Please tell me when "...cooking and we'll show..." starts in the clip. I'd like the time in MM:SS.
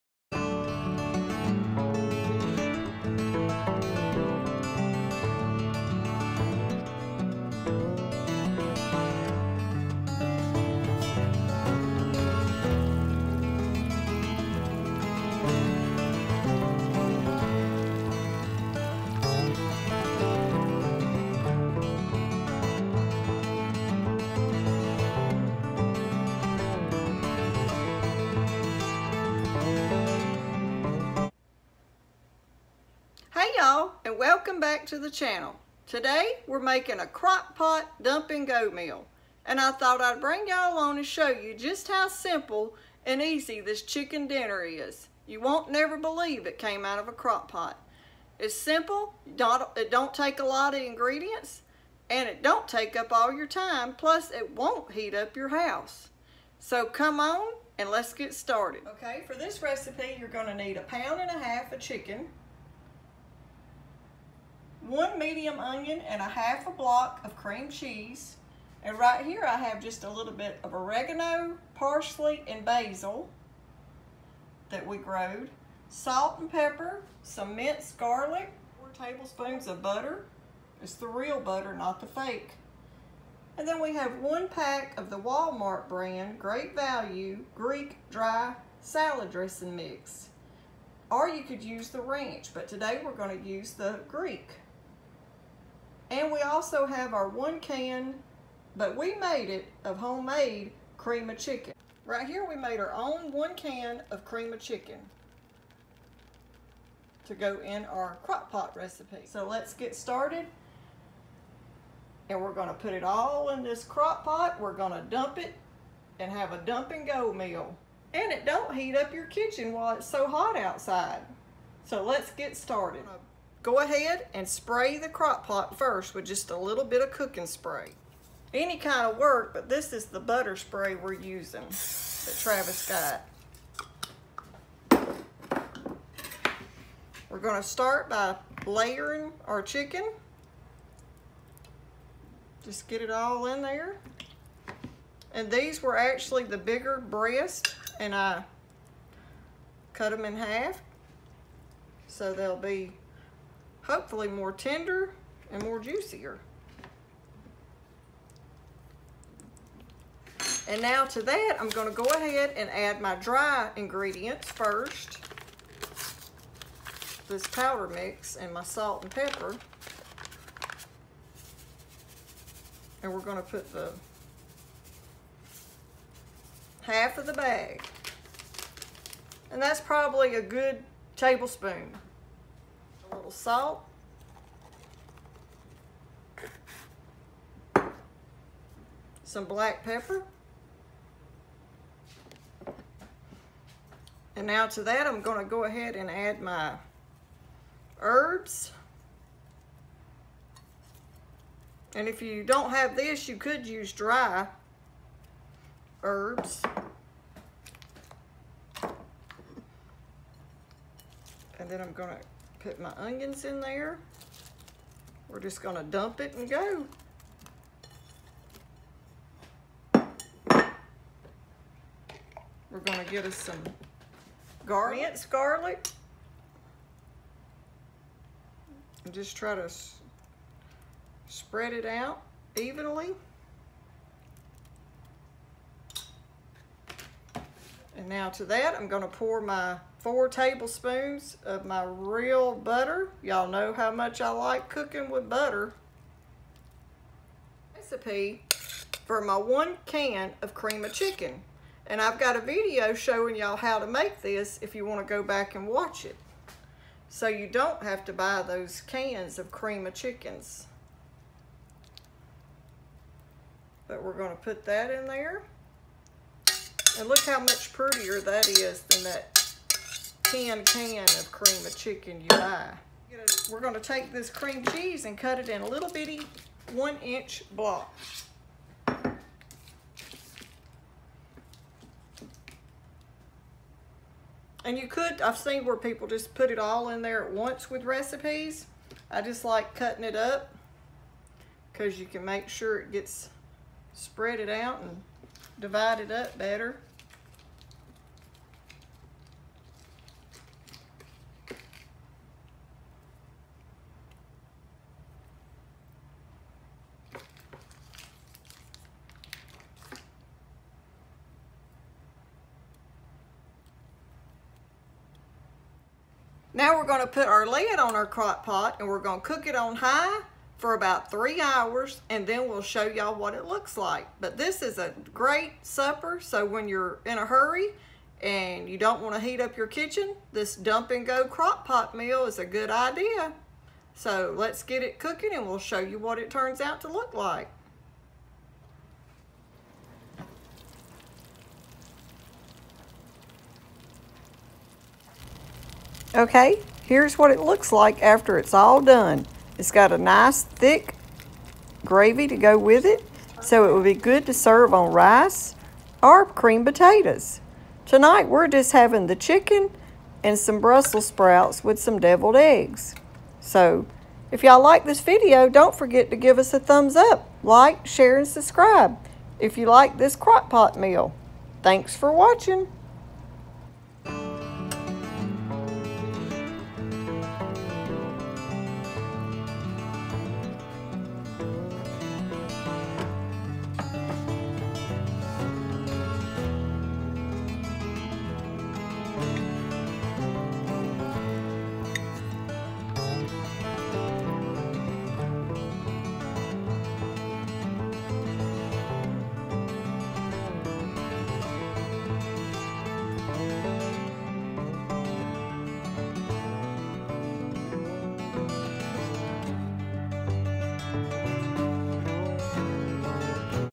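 05:34.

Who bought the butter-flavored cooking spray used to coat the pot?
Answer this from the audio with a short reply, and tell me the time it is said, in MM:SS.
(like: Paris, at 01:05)
Travis, at 02:12.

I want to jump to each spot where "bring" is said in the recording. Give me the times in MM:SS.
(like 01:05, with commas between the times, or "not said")
00:40.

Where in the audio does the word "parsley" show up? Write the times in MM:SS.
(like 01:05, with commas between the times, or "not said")
01:11.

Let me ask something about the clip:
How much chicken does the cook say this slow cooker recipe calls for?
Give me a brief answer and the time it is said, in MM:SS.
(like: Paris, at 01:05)
1.5 pounds, at 01:00.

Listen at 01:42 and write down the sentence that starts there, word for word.
Right here we made our own one can of cream of chicken to go in our crock pot recipe.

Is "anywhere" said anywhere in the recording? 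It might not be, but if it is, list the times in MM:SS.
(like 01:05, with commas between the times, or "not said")
not said.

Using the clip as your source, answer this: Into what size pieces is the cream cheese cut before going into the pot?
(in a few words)
1 inch blocks.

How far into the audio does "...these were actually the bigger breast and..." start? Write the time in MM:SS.
02:25.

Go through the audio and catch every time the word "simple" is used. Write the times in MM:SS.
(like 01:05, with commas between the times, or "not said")
00:42, 00:48.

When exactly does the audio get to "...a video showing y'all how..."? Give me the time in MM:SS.
04:12.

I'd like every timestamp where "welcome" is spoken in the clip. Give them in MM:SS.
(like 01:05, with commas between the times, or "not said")
00:34.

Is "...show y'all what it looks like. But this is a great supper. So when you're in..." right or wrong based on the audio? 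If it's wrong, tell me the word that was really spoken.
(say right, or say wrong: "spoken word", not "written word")
right.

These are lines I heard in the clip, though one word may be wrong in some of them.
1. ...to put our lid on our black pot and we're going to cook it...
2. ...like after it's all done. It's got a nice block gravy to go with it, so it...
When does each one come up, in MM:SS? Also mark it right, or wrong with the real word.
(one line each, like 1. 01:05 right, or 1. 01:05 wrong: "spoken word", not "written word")
1. 05:17 wrong: "crock", not "black"
2. 05:47 wrong: "thick", not "block".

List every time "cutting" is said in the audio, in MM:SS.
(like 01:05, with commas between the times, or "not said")
04:49.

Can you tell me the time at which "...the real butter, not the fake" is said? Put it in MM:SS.
01:20.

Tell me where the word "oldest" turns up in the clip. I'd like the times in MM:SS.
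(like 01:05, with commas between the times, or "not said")
not said.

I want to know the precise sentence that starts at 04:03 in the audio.
Y'all know how much I like cooking with butter.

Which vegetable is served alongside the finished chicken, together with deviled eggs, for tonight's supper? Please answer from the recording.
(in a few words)
Brussels sprouts.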